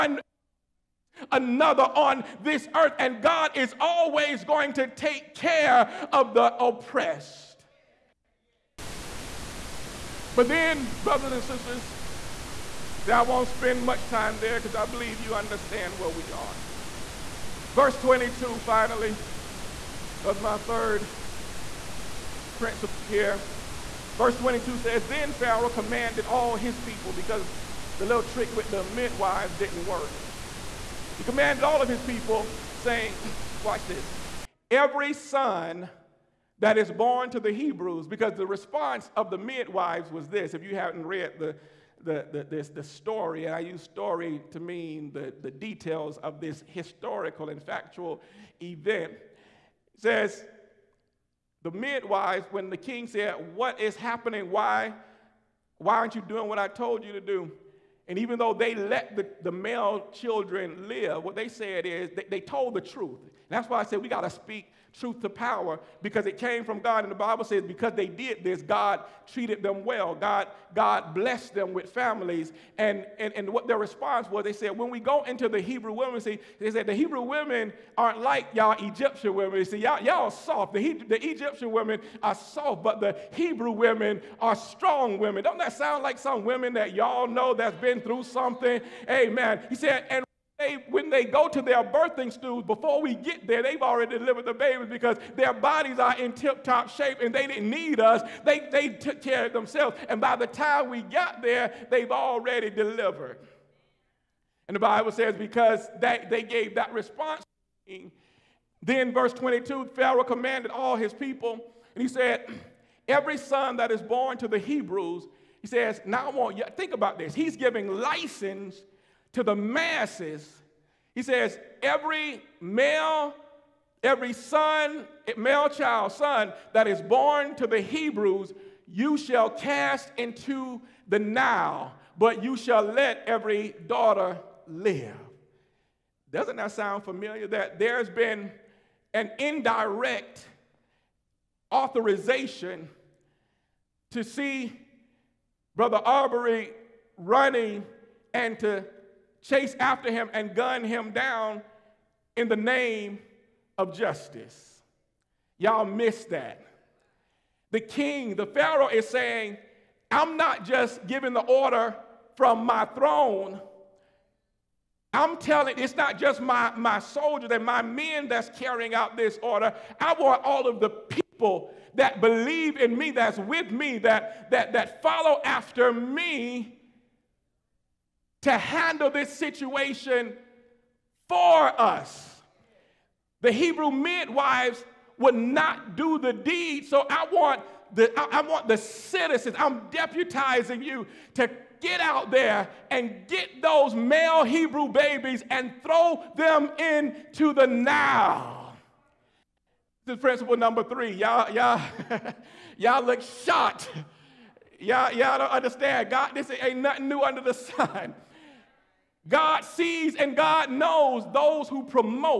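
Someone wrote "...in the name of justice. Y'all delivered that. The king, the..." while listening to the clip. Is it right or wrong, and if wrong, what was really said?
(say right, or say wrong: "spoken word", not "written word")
wrong: "missed", not "delivered".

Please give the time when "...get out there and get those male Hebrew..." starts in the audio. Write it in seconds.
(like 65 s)
191 s.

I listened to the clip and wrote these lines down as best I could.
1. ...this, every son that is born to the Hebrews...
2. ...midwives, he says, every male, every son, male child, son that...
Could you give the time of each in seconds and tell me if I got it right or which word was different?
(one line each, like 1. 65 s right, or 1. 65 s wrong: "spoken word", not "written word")
1. 33 s right
2. 119 s wrong: "masses", not "midwives".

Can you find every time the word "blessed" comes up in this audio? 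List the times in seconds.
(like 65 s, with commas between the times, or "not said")
71 s.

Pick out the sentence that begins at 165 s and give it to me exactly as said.
I'm telling it's not just my, my soldiers and my men that's carrying out this order.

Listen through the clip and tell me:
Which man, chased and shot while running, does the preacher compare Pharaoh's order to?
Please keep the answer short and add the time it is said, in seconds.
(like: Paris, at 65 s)
Brother Arbery, at 145 s.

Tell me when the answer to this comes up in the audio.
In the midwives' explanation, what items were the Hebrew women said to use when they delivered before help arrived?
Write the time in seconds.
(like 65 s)
91 s.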